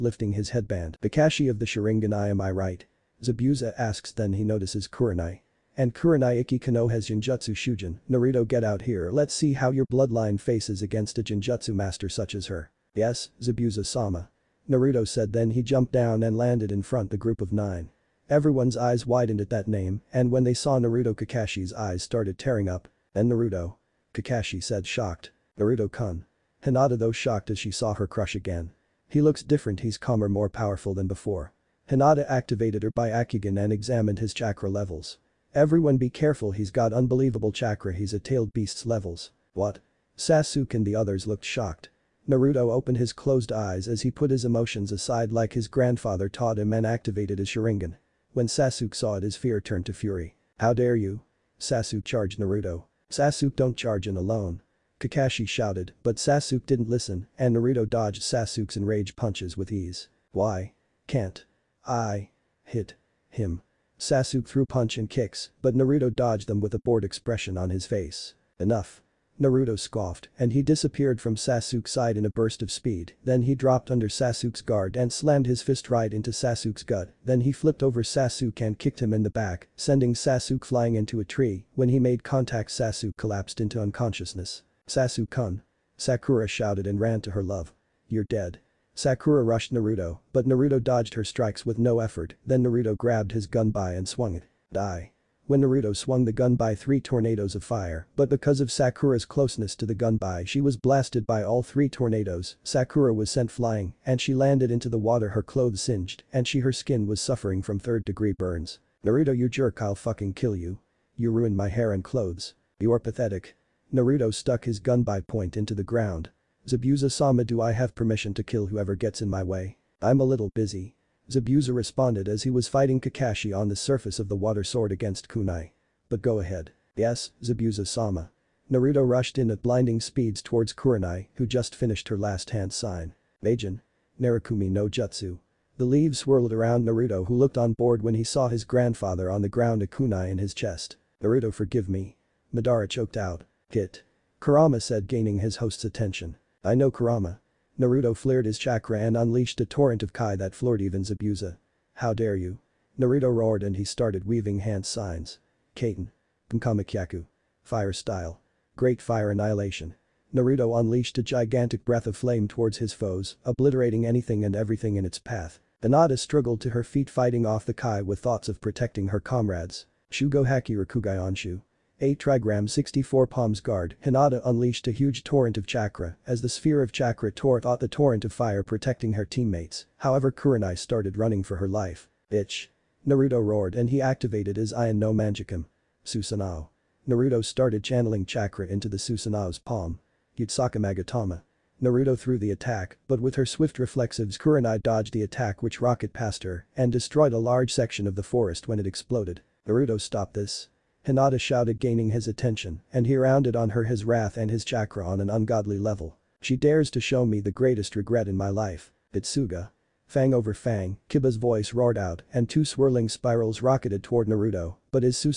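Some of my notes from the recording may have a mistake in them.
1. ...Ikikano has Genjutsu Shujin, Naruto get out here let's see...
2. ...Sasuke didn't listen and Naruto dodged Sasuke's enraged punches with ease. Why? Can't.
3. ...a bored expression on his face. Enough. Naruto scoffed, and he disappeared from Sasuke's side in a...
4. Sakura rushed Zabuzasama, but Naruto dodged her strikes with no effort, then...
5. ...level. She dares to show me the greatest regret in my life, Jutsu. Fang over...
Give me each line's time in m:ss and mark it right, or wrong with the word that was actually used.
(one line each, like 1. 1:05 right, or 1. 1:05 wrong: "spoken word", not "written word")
1. 0:06 right
2. 0:56 right
3. 1:06 right
4. 1:28 wrong: "Naruto", not "Zabuzasama"
5. 3:25 wrong: "Itsuga", not "Jutsu".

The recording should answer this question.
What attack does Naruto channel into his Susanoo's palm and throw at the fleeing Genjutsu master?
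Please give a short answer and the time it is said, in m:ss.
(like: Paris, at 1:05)
Yasaka Magatama, at 3:10.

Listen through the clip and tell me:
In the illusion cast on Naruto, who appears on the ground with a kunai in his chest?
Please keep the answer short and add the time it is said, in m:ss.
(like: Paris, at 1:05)
Madara, at 2:22.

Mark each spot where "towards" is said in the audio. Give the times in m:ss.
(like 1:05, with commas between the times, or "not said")
2:10, 2:42, 3:34.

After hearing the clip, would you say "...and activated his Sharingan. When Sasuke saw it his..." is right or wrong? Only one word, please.
right.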